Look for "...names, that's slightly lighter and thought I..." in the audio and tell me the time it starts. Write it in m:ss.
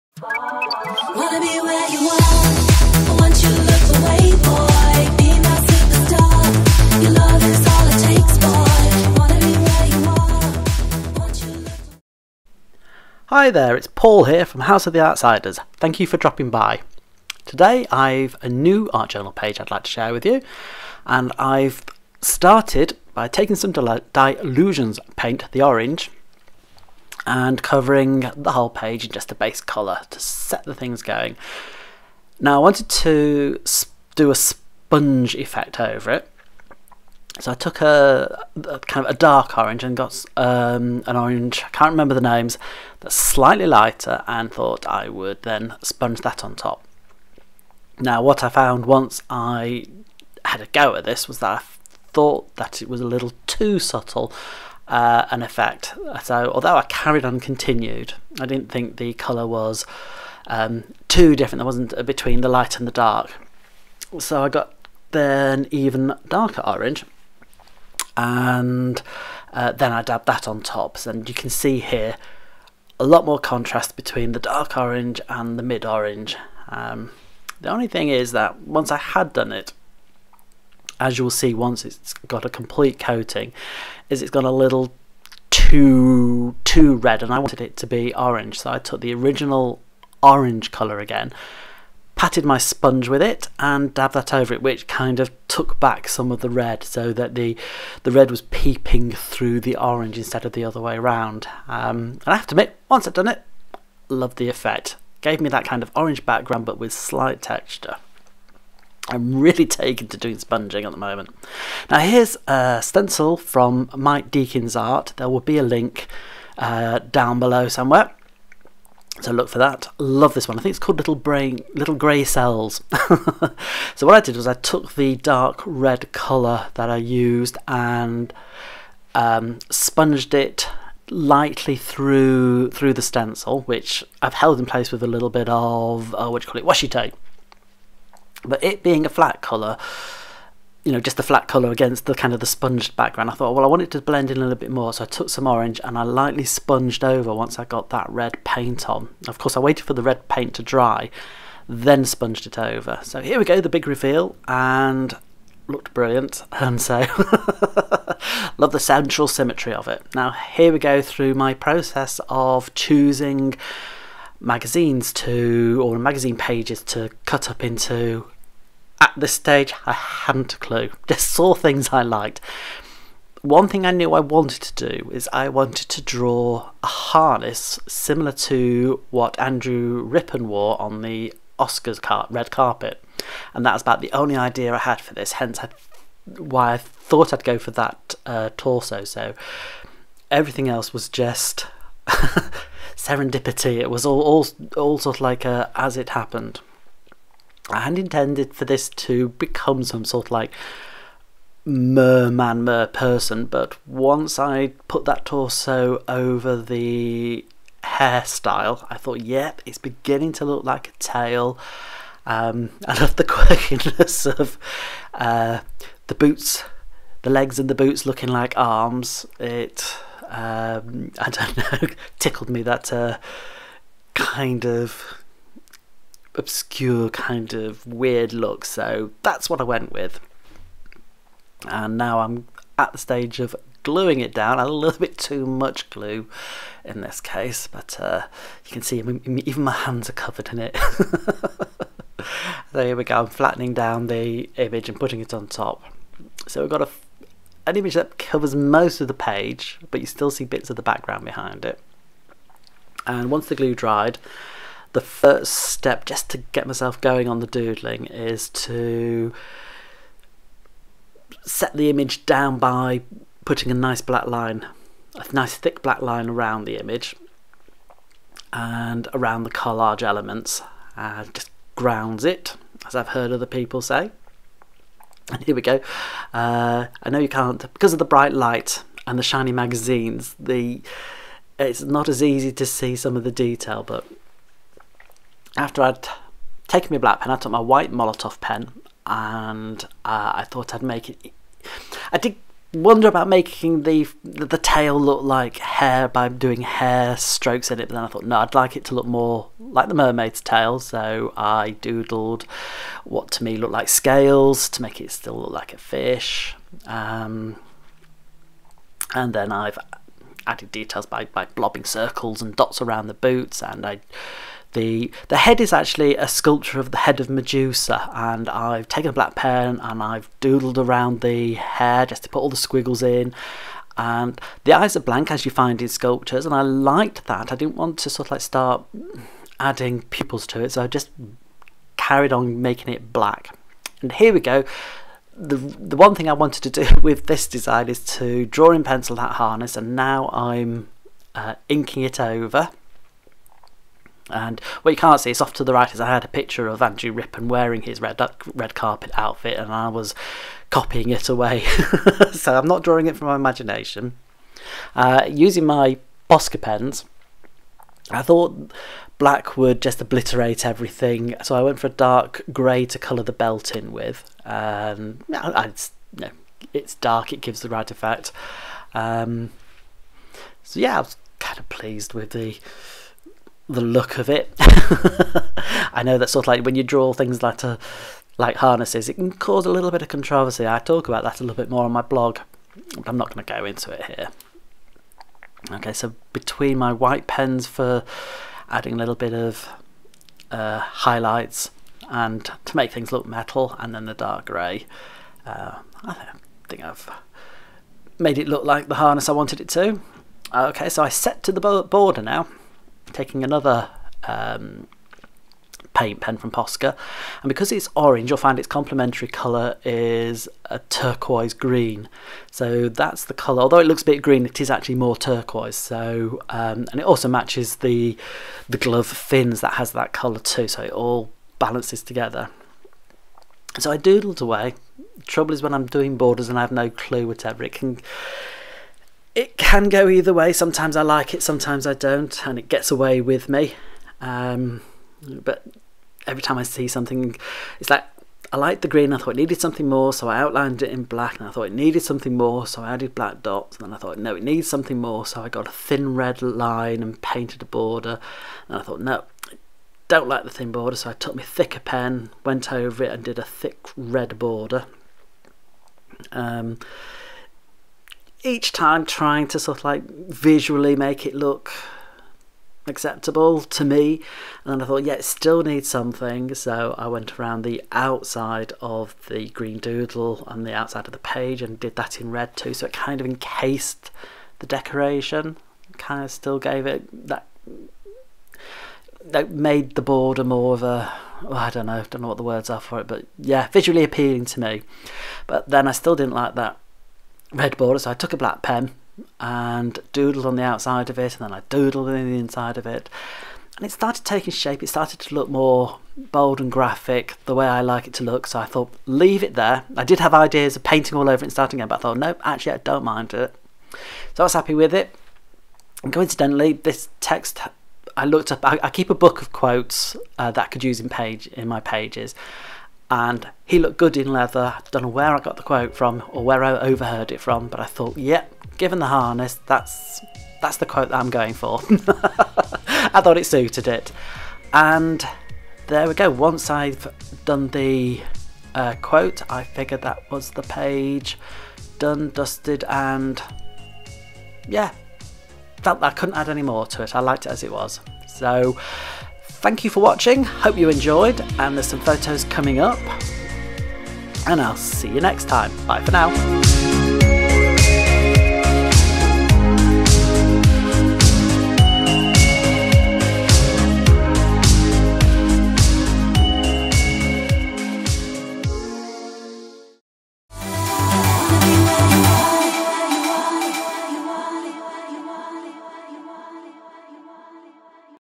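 0:42.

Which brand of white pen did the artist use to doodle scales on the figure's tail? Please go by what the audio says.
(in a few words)
Molotow.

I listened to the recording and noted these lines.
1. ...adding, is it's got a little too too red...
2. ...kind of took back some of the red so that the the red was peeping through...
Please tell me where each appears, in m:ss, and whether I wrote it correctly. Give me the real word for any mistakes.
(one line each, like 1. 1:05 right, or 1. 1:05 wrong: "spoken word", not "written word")
1. 1:22 wrong: "coating", not "adding"
2. 1:34 right.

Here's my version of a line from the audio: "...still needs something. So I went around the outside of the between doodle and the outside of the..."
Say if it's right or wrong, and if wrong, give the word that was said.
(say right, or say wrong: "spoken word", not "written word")
wrong: "green", not "between".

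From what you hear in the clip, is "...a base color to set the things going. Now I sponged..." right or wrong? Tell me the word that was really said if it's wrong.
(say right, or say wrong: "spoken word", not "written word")
wrong: "wanted", not "sponged".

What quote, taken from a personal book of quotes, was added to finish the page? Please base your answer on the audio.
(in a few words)
he looked good in leather.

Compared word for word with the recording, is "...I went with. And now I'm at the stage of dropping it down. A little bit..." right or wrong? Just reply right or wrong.
wrong.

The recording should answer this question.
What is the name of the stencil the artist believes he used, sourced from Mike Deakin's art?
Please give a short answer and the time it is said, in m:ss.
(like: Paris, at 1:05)
Little Grey Cells, at 2:01.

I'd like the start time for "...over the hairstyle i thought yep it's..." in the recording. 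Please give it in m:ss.
3:26.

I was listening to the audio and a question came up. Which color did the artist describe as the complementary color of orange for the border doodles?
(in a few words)
turquoise green.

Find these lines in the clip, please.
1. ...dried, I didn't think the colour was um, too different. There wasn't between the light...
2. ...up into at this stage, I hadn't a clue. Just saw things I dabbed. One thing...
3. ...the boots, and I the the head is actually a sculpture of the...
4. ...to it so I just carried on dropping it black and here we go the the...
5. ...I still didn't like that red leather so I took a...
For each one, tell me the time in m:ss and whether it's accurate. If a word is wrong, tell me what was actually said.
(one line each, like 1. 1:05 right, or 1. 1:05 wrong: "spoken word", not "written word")
1. 0:57 wrong: "continued", not "dried"
2. 2:47 wrong: "liked", not "dabbed"
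3. 5:13 right
4. 5:30 wrong: "making", not "dropping"
5. 8:05 wrong: "border", not "leather".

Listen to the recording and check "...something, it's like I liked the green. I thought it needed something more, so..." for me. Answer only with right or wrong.
right.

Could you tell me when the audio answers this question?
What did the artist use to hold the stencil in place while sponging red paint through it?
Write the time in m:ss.
2:16.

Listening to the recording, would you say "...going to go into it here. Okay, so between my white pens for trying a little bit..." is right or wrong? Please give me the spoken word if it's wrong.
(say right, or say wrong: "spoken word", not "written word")
wrong: "adding", not "trying".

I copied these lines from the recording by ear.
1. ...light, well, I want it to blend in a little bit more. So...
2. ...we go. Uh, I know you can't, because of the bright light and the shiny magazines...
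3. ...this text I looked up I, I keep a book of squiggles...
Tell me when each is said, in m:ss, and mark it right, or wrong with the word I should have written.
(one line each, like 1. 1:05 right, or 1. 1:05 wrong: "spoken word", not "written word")
1. 2:23 wrong: "thought", not "light"
2. 4:35 right
3. 8:26 wrong: "quotes", not "squiggles".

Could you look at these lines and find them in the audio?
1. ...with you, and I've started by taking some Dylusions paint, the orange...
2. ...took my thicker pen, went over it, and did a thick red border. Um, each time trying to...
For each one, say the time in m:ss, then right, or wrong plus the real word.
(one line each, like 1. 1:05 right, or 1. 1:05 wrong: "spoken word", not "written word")
1. 0:20 right
2. 7:31 right.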